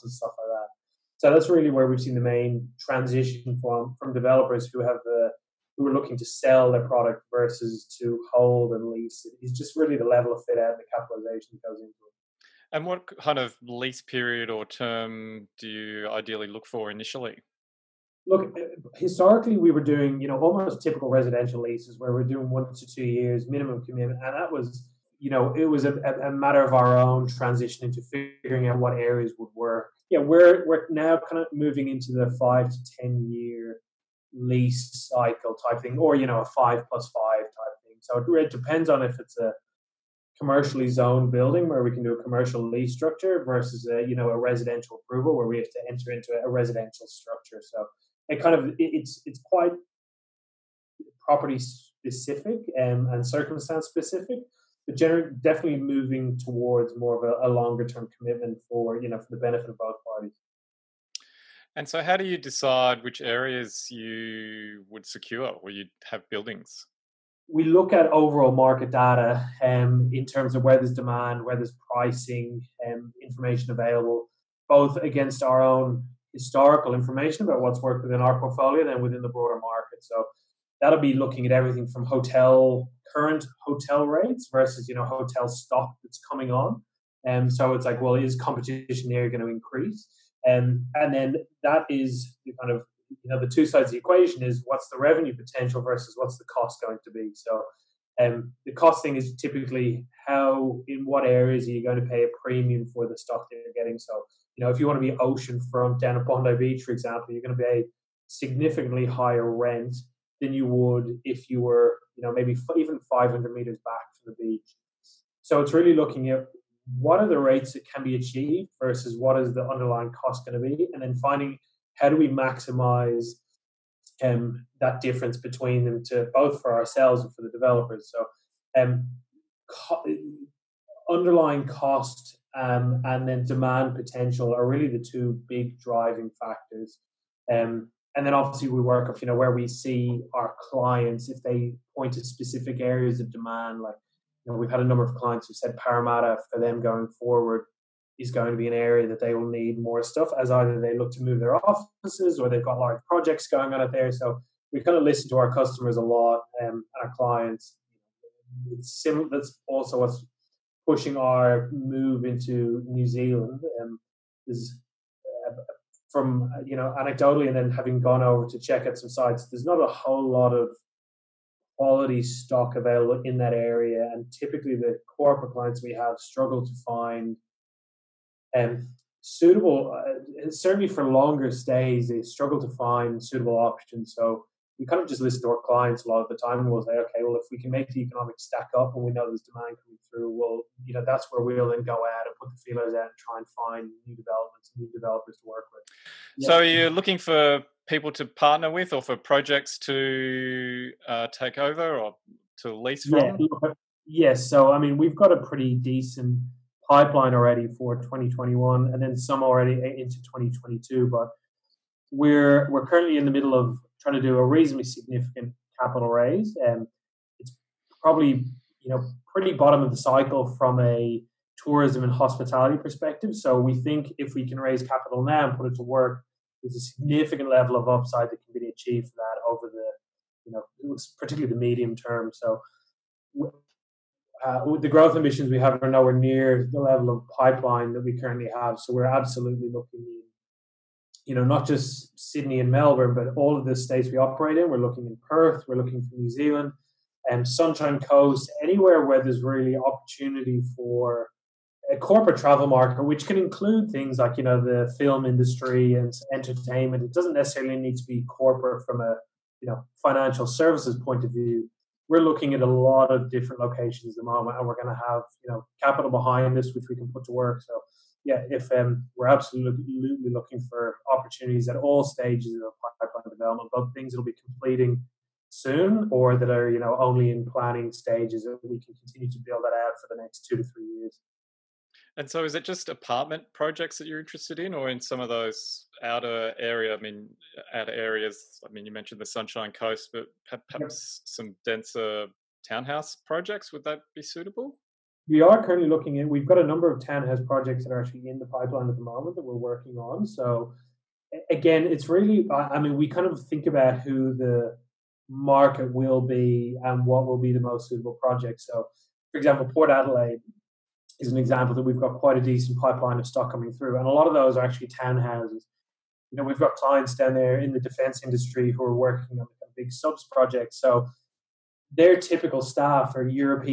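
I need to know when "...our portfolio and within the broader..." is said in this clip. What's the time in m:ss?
1:18.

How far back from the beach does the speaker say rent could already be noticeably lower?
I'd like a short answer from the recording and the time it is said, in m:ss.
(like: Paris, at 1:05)
500 meters, at 1:53.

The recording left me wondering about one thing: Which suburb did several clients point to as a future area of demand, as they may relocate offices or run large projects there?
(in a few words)
Parramatta.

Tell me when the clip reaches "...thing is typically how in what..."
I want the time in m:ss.
1:39.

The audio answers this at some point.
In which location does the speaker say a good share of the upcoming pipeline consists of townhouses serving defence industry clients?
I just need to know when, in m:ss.
5:09.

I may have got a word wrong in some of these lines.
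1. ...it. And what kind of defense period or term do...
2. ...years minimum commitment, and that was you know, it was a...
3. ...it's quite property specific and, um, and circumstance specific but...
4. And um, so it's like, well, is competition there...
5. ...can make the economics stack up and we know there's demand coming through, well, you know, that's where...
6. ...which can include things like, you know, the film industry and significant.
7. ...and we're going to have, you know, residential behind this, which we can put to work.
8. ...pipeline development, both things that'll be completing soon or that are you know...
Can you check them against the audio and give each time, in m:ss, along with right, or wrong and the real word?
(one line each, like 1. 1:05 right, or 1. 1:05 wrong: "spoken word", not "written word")
1. 0:12 wrong: "lease", not "defense"
2. 0:23 right
3. 0:49 right
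4. 1:27 right
5. 3:07 right
6. 4:13 wrong: "entertainment", not "significant"
7. 4:24 wrong: "capital", not "residential"
8. 4:32 right.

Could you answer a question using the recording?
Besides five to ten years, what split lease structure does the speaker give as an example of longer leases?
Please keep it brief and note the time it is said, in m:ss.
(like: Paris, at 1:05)
5 plus 5, at 0:36.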